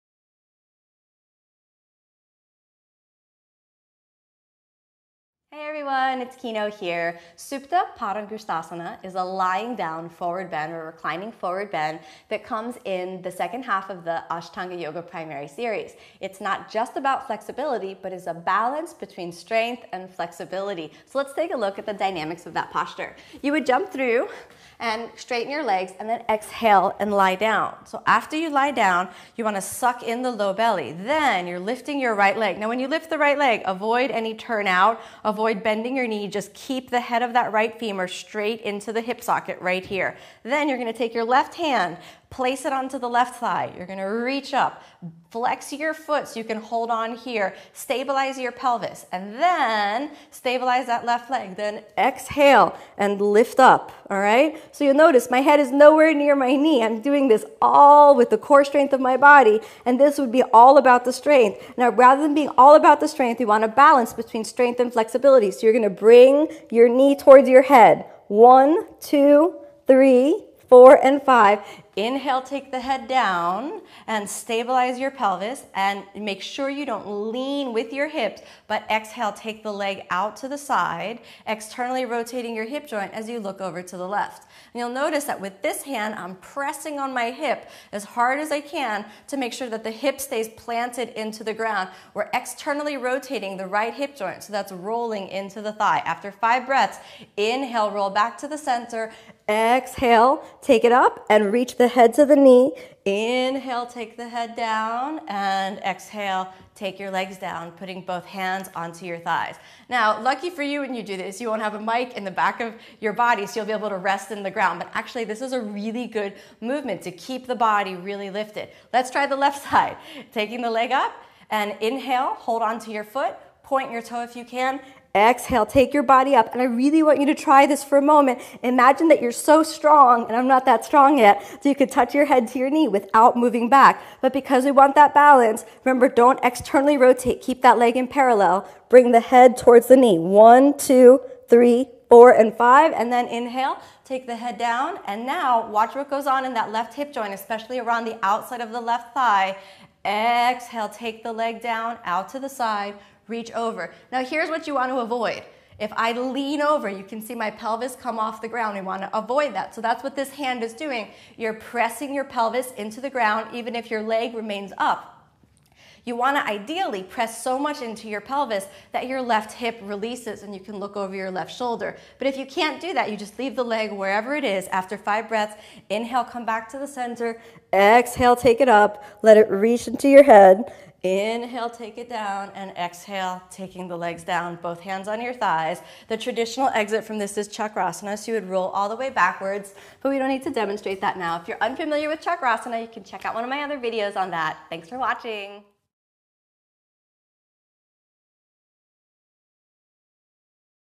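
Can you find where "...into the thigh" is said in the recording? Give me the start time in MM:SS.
01:35.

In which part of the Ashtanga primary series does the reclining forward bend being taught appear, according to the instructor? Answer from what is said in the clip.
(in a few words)
second half.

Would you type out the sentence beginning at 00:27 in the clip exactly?
So after you lie down, you want to suck in the low belly.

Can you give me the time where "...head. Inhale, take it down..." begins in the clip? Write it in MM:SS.
03:00.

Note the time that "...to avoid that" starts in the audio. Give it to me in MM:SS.
02:39.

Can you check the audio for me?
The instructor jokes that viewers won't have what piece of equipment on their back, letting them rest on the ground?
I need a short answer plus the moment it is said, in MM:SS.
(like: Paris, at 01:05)
mic, at 01:51.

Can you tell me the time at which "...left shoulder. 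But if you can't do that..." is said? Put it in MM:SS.
02:51.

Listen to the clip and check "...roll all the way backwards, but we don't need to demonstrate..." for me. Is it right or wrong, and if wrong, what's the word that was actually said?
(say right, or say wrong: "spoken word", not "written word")
right.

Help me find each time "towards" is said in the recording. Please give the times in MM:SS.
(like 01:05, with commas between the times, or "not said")
01:07, 02:19.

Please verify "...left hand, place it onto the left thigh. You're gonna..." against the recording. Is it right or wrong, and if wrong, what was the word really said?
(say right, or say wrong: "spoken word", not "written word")
right.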